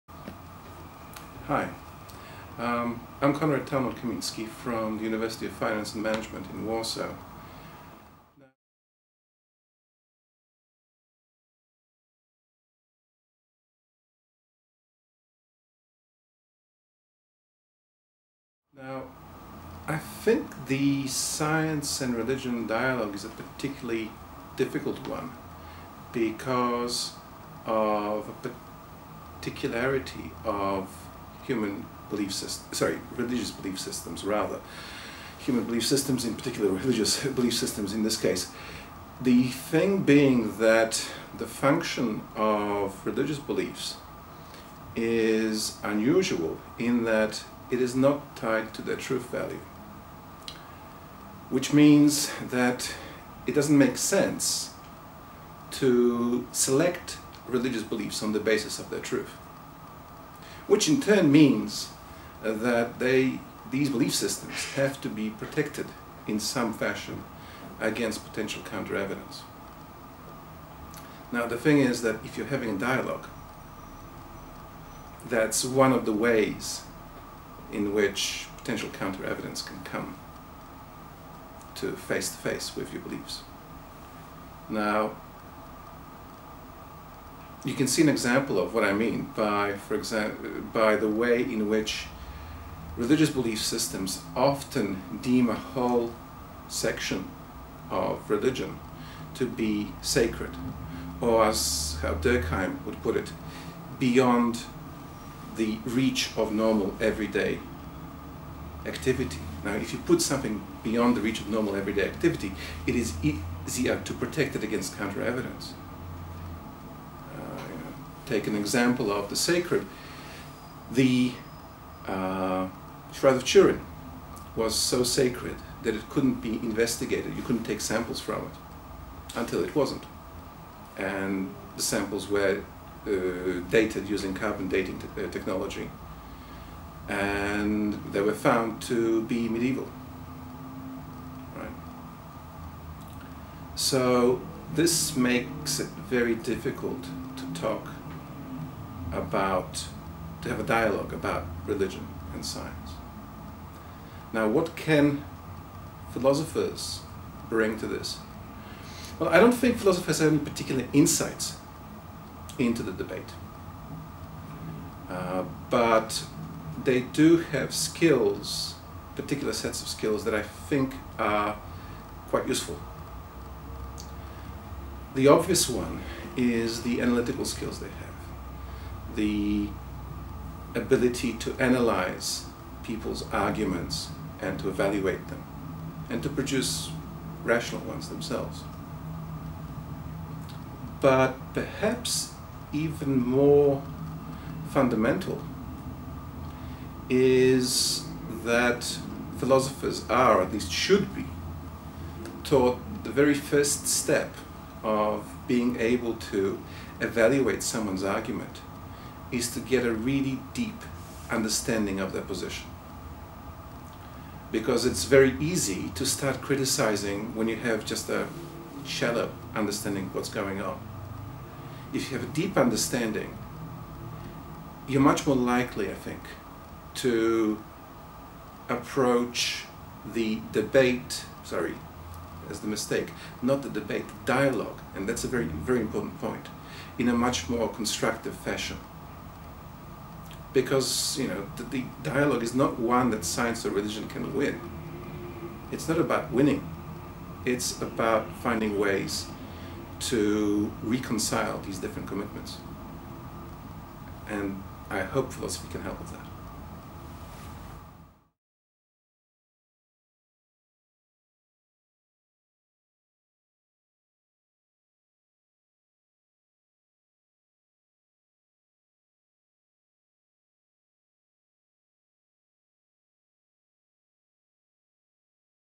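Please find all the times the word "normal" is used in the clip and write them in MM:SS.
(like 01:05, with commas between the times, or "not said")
01:46, 01:51.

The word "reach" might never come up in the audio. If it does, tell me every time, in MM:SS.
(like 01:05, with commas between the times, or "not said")
01:45, 01:51.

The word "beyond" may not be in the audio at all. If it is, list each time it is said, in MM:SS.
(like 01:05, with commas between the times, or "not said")
01:43, 01:50.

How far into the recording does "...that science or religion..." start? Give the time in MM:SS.
04:03.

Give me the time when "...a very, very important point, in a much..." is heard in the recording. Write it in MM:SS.
03:55.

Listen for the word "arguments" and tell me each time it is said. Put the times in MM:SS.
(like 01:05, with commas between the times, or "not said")
03:03, 03:28.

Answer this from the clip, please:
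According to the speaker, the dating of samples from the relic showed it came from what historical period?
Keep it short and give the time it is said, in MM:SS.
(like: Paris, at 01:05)
Medieval, at 02:19.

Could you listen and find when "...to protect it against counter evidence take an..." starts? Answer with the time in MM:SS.
01:54.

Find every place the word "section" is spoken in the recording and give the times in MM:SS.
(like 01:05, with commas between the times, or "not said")
01:36.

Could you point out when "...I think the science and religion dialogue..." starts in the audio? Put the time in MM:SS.
00:19.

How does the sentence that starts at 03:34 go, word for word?
Because it's very easy to start criticizing when you have just a shallow understanding of what's going on.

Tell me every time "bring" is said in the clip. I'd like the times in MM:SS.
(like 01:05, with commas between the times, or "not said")
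02:37.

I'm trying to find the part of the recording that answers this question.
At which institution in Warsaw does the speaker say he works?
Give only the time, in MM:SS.
00:05.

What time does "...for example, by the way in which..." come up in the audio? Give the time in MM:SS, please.
01:29.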